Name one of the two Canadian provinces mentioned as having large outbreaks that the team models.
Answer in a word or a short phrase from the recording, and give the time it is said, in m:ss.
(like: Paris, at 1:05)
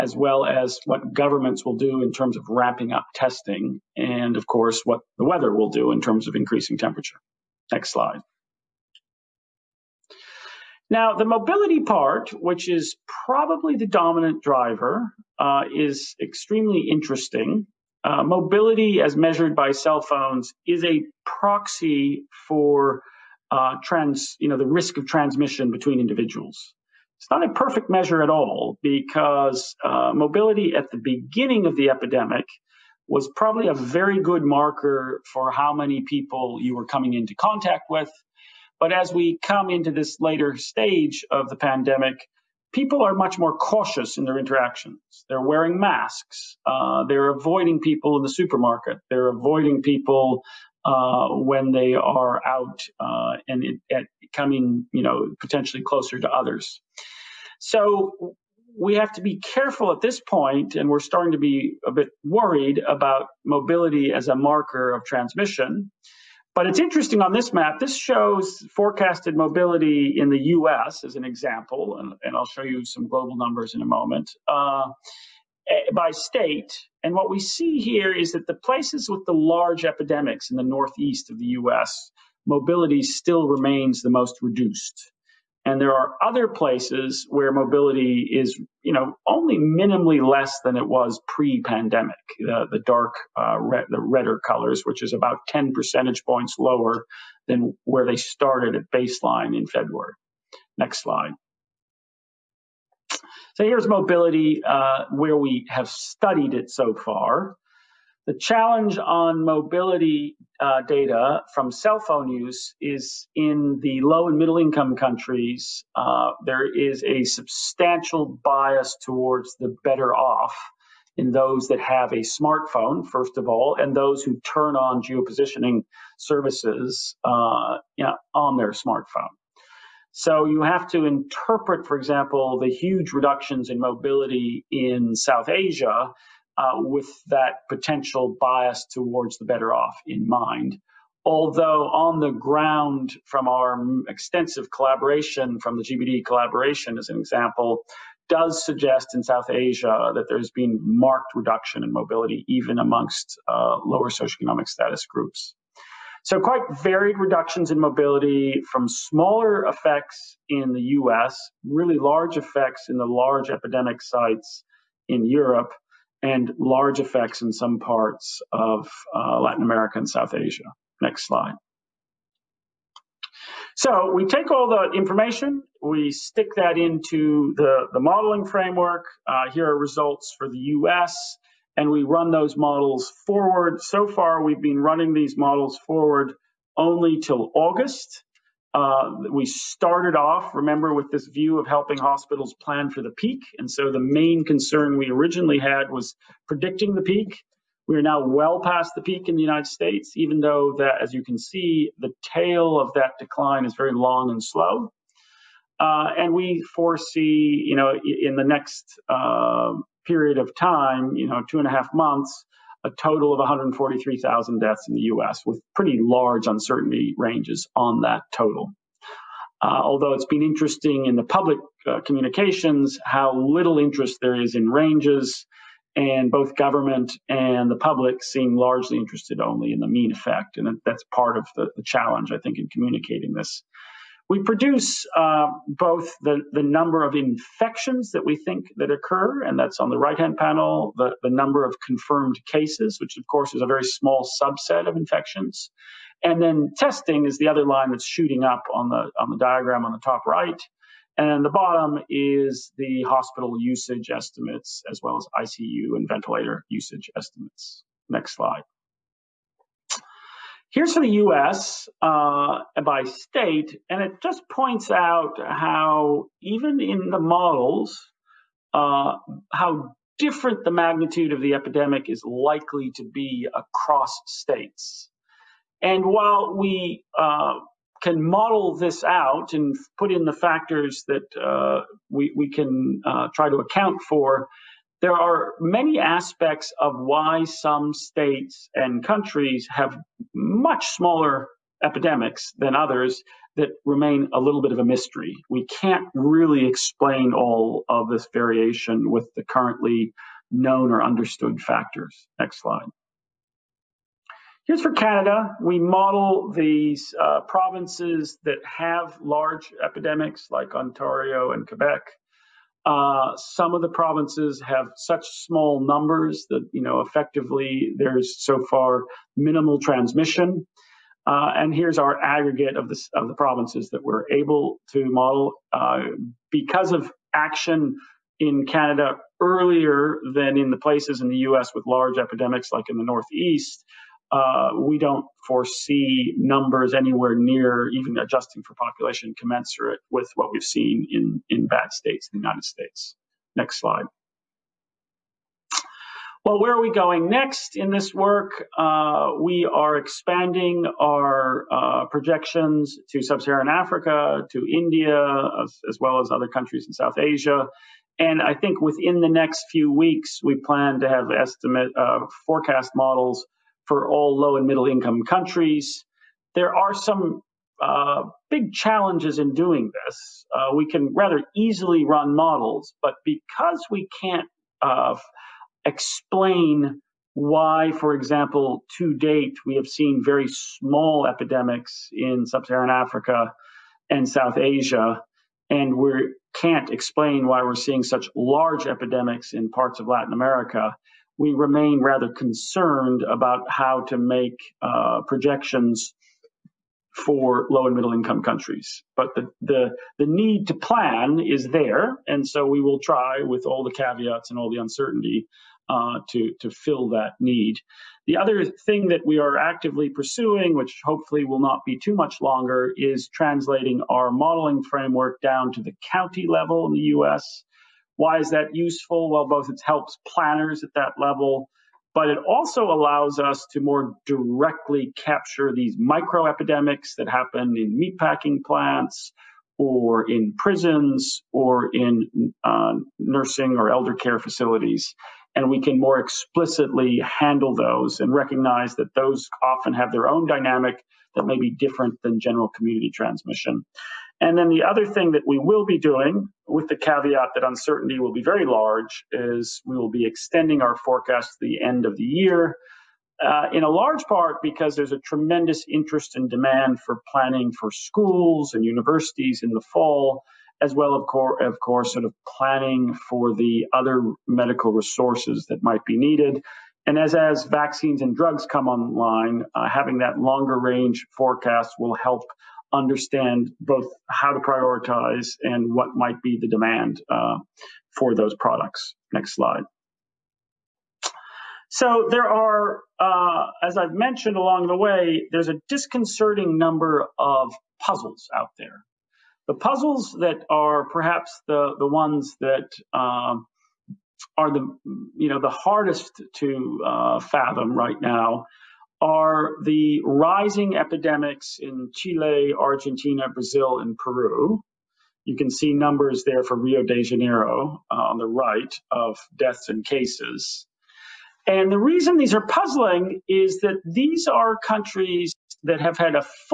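Ontario, at 5:10.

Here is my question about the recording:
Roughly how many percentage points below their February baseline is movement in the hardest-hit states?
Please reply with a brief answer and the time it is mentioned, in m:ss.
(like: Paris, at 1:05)
10, at 1:35.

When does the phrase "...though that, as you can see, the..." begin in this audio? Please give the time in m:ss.
3:20.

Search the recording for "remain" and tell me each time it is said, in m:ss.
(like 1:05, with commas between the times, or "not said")
1:23, 4:53, 6:31.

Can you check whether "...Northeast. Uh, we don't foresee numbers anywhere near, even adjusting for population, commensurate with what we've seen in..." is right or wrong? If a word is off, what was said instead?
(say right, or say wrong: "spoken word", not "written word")
right.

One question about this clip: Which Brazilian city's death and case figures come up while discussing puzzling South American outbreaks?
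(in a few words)
Rio de Janeiro.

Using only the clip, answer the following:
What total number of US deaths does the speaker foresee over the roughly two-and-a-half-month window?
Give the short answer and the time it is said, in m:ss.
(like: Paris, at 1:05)
143,000, at 3:33.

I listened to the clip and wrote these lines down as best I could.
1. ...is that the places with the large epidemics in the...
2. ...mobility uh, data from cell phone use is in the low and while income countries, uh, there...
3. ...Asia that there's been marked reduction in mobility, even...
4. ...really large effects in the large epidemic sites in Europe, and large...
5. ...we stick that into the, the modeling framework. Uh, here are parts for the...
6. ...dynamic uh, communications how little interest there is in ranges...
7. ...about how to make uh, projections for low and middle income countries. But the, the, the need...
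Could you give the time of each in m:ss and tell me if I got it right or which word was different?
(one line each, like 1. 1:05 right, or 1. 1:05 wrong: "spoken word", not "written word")
1. 1:18 right
2. 1:49 wrong: "middle", not "while"
3. 2:29 right
4. 2:41 right
5. 2:55 wrong: "results", not "parts"
6. 3:41 wrong: "public", not "dynamic"
7. 6:33 right.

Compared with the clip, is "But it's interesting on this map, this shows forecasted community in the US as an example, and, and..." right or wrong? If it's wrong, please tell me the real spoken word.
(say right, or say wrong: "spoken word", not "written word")
wrong: "mobility", not "community".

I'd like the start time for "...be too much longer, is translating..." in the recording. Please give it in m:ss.
6:51.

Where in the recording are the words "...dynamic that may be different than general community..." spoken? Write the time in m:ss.
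7:20.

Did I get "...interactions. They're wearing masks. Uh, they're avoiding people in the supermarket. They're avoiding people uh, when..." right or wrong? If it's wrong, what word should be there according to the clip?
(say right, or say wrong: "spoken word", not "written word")
right.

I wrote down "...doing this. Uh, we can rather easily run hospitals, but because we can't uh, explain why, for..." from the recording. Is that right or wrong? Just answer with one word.
wrong.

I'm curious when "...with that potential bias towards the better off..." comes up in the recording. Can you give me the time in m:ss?
2:16.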